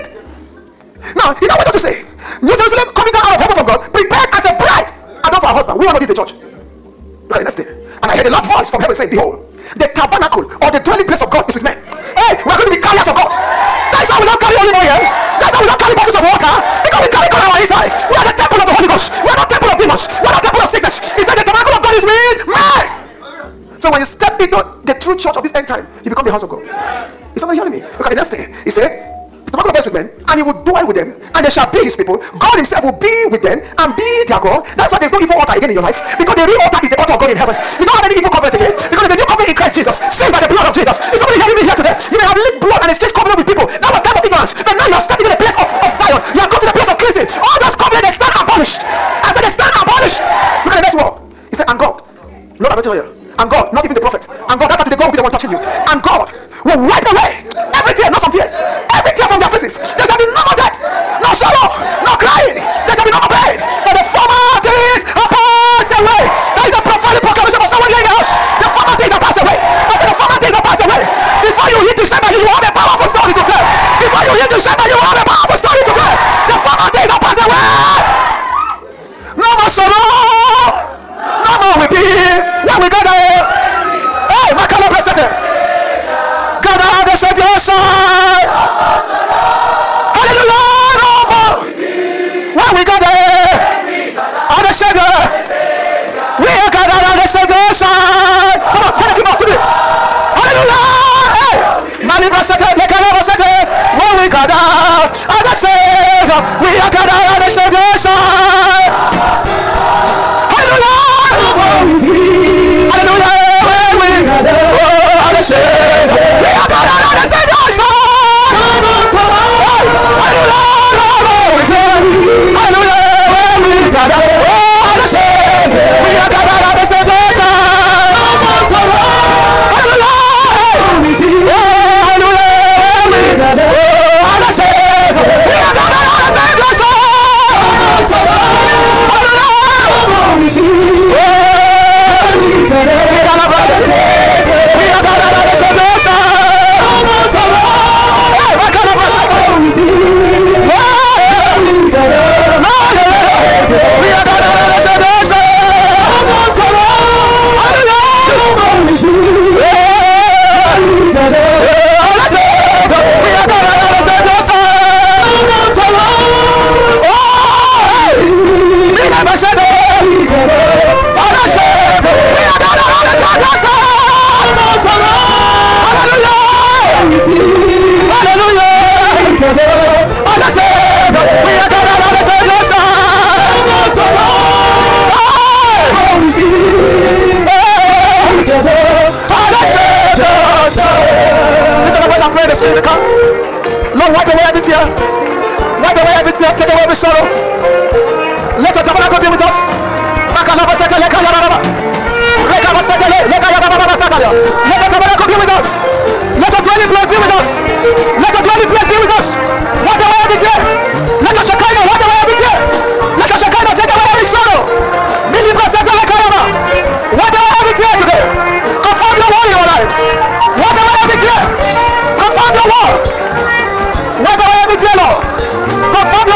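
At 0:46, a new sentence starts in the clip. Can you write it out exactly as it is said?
You have come to the place of cleansing.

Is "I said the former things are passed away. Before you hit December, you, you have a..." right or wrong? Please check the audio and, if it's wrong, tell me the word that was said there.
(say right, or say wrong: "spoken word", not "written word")
right.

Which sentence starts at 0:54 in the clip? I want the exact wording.
And God, that's how today God will be the one touching you.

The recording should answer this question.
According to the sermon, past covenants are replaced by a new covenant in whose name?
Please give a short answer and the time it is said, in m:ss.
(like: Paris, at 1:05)
Christ Jesus, at 0:39.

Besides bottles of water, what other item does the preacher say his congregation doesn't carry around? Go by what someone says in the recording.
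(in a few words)
olive oil.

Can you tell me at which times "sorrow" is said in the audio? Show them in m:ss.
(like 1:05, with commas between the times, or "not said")
1:01, 1:19.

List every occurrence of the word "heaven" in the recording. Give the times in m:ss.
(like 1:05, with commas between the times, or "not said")
0:03, 0:08, 0:37.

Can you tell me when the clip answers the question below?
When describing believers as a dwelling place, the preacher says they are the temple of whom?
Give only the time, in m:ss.
0:18.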